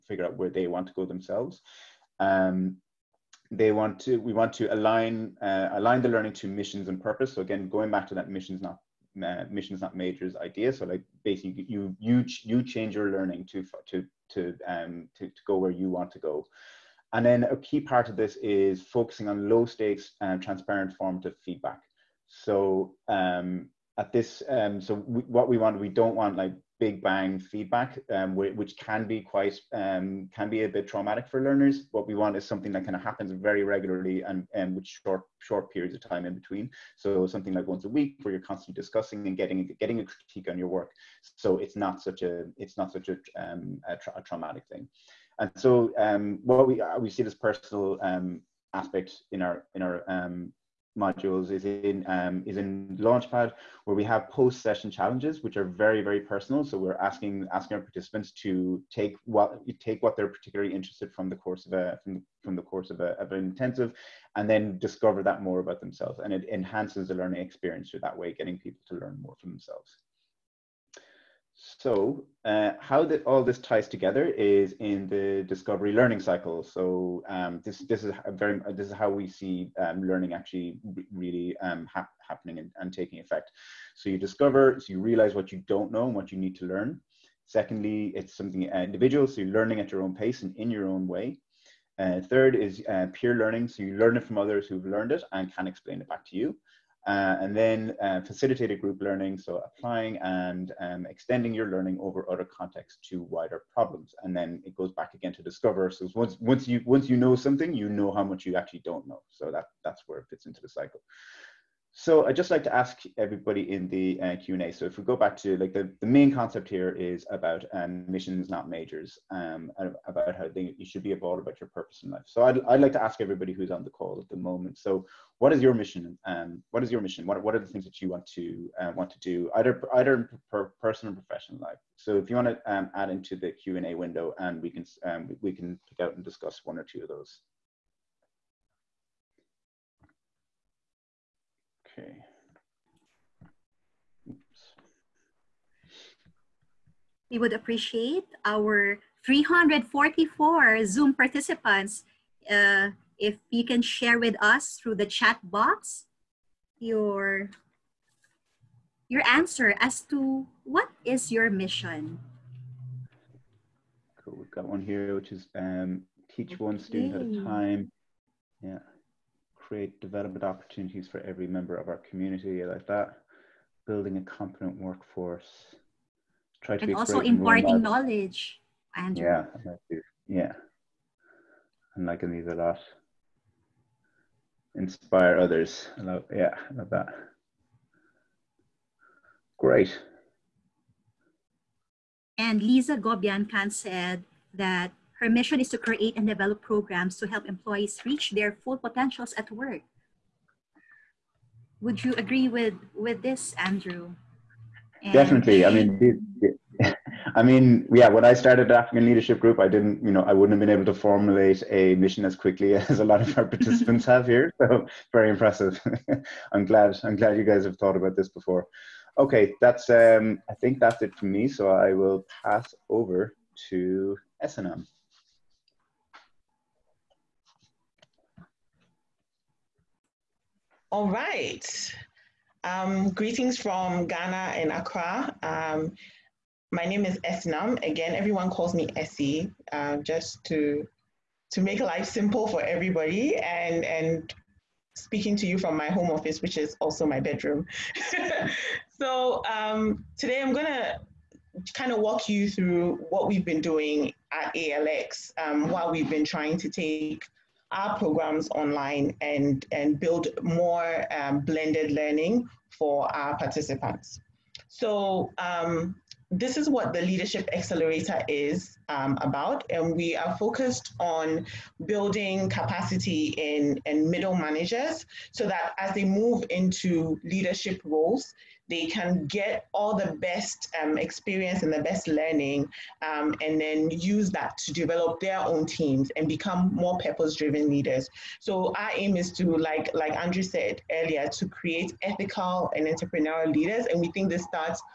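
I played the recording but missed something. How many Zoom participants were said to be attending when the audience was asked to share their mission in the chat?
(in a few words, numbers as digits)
344.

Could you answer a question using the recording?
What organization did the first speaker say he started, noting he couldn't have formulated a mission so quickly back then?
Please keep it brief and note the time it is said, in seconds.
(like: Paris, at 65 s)
African Leadership Group, at 208 s.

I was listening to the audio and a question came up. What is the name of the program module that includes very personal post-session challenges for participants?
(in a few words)
Launchpad.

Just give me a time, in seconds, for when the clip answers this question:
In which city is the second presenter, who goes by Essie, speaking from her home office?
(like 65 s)
234 s.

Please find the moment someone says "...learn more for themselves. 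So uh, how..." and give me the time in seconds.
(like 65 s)
68 s.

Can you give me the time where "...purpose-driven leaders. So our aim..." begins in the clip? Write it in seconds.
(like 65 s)
286 s.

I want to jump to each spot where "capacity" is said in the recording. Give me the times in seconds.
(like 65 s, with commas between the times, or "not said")
272 s.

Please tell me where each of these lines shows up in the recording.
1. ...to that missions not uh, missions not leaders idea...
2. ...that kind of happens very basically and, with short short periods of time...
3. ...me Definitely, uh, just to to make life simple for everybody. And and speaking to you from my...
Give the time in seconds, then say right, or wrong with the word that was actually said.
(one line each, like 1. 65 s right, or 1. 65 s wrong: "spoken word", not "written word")
1. 8 s wrong: "majors", not "leaders"
2. 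32 s wrong: "regularly", not "basically"
3. 238 s wrong: "Essie", not "Definitely".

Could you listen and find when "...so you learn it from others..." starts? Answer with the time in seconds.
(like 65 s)
93 s.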